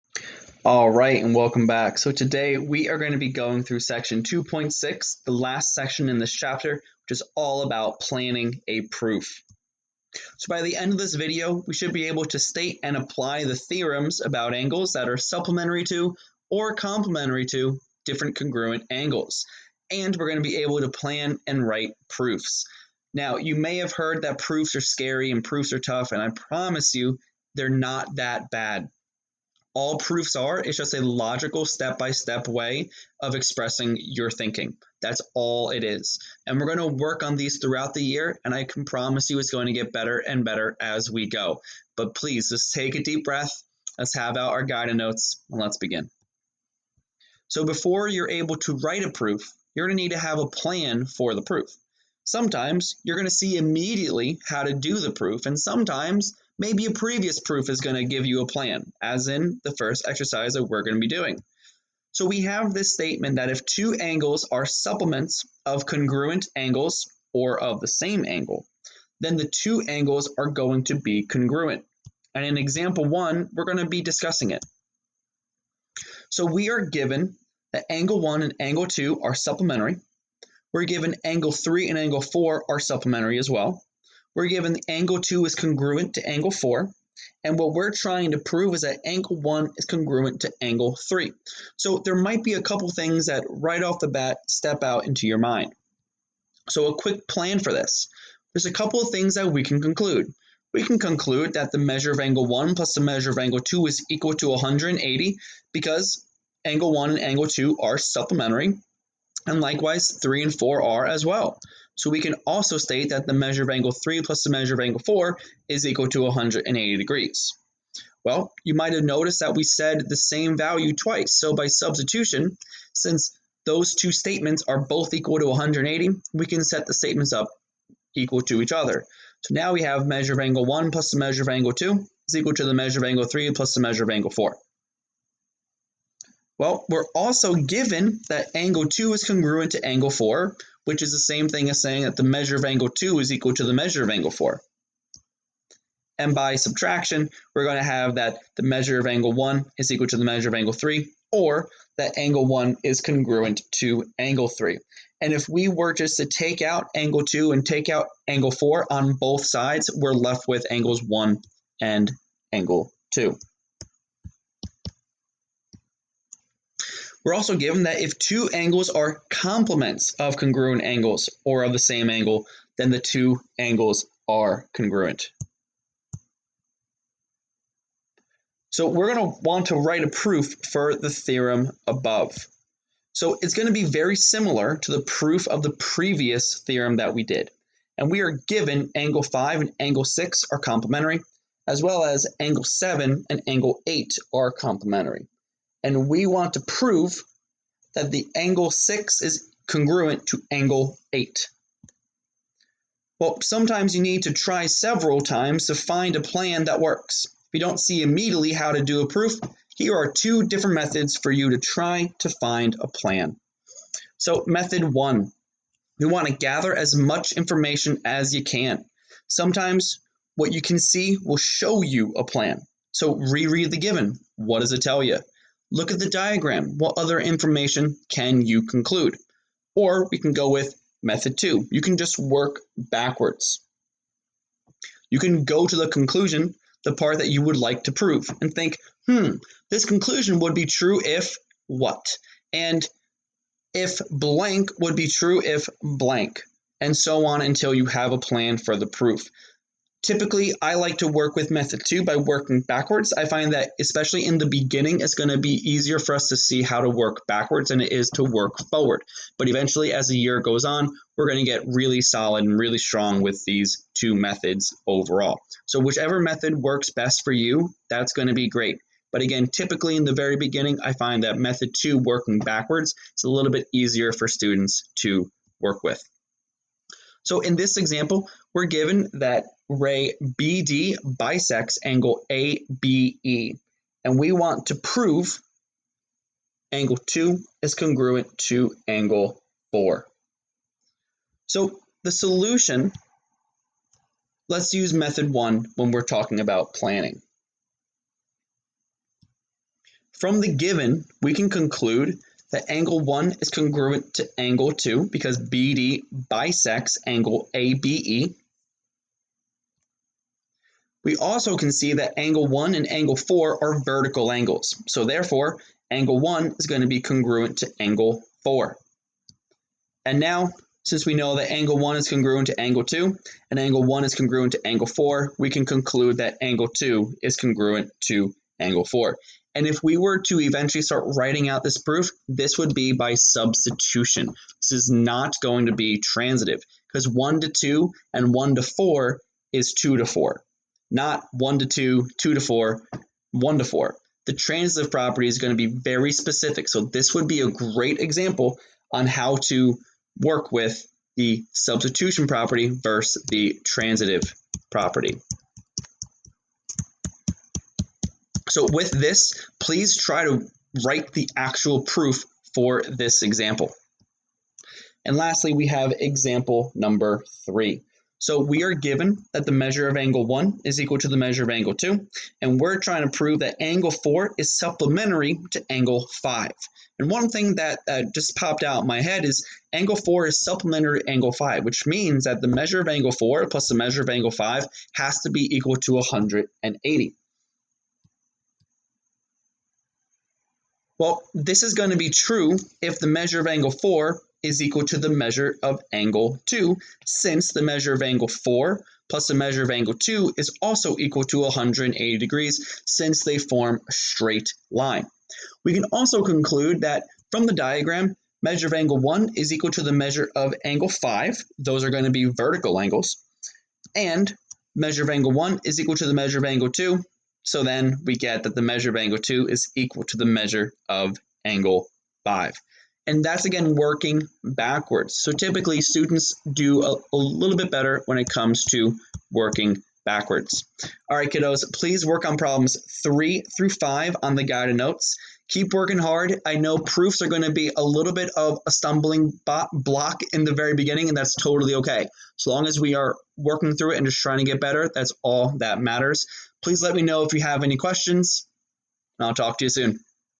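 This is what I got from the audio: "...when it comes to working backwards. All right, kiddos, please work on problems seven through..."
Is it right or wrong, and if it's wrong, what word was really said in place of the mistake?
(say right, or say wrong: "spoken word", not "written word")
wrong: "three", not "seven".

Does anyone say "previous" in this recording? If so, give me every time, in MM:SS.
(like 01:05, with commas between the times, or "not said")
00:56, 03:05.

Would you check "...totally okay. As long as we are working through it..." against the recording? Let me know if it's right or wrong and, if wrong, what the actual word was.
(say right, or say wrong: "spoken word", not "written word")
right.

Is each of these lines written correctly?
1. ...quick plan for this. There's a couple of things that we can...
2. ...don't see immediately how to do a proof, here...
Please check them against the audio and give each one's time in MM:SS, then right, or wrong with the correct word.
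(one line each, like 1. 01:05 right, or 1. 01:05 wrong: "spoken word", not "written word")
1. 01:36 right
2. 03:27 right.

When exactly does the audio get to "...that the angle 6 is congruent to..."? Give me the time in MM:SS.
03:17.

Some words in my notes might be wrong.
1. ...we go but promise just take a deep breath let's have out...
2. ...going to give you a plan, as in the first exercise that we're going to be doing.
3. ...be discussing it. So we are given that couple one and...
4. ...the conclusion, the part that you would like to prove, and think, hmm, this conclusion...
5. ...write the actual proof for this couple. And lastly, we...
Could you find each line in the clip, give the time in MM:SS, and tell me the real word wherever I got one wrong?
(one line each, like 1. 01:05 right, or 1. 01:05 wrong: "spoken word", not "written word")
1. 00:41 wrong: "please", not "promise"
2. 00:57 right
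3. 01:13 wrong: "angle", not "couple"
4. 03:55 right
5. 06:00 wrong: "example", not "couple".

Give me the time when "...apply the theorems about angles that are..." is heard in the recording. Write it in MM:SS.
00:12.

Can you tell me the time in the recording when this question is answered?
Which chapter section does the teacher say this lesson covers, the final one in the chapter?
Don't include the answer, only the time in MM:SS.
00:03.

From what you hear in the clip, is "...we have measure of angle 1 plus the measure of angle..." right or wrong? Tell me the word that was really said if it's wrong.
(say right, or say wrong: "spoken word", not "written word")
right.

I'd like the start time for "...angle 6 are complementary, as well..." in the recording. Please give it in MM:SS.
03:09.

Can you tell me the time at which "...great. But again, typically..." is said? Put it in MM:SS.
04:28.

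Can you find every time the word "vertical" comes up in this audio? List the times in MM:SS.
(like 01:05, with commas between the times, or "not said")
05:13, 06:52.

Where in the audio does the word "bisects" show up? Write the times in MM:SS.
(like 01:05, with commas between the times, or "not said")
04:41, 05:06.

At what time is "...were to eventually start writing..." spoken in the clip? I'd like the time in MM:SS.
05:29.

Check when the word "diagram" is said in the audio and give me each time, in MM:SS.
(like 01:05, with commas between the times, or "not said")
03:46, 06:47.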